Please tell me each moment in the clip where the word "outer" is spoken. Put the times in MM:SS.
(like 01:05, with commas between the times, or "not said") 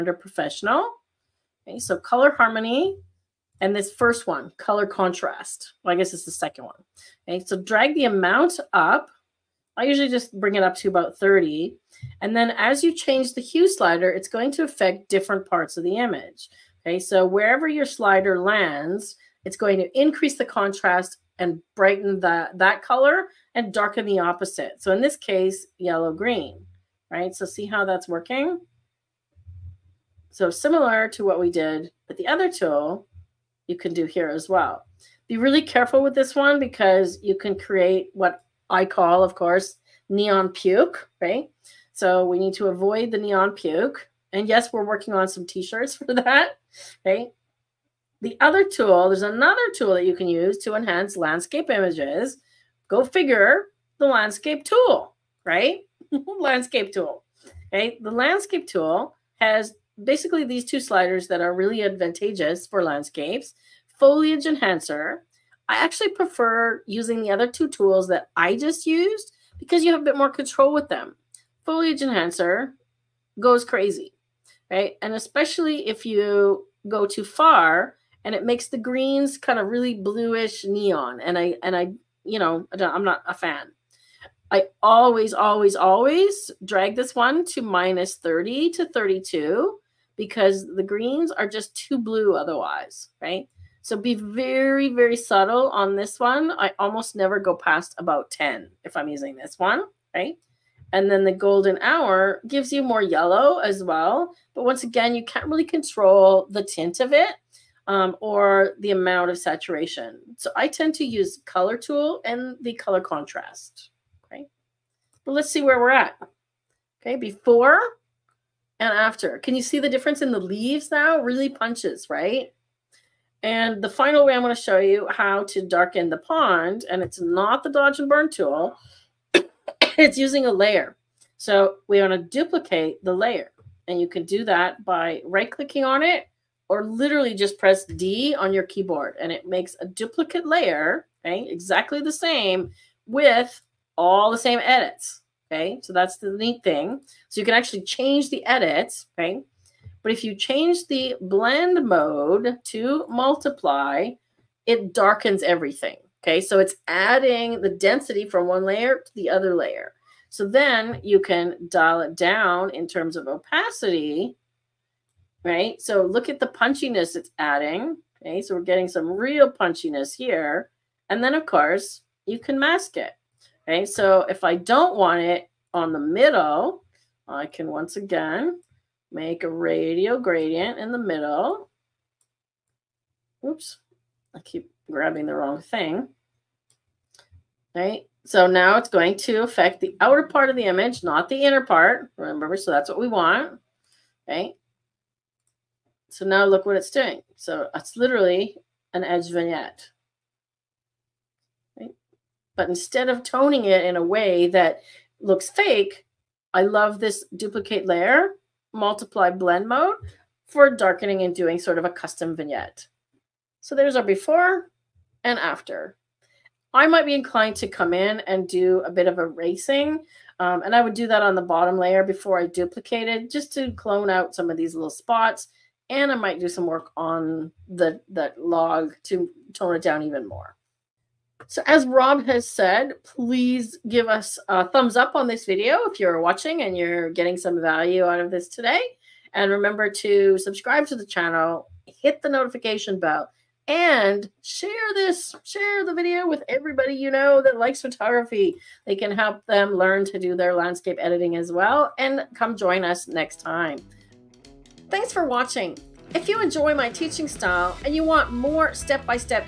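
03:10.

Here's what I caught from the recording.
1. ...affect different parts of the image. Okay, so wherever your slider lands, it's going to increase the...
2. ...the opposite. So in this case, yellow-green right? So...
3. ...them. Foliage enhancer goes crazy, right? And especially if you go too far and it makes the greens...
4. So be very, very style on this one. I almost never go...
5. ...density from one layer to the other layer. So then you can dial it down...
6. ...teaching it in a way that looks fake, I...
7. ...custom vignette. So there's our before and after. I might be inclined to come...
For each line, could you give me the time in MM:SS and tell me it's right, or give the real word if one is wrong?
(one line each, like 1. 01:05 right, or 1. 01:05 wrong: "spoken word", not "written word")
1. 00:14 right
2. 00:24 right
3. 01:10 right
4. 01:33 wrong: "subtle", not "style"
5. 02:37 right
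6. 03:23 wrong: "toning", not "teaching"
7. 03:31 right.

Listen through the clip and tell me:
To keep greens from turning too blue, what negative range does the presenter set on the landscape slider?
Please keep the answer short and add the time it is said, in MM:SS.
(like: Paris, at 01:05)
-30 to 32, at 01:27.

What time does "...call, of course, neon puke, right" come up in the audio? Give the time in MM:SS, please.
00:38.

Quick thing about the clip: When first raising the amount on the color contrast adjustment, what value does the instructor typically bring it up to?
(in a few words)
30.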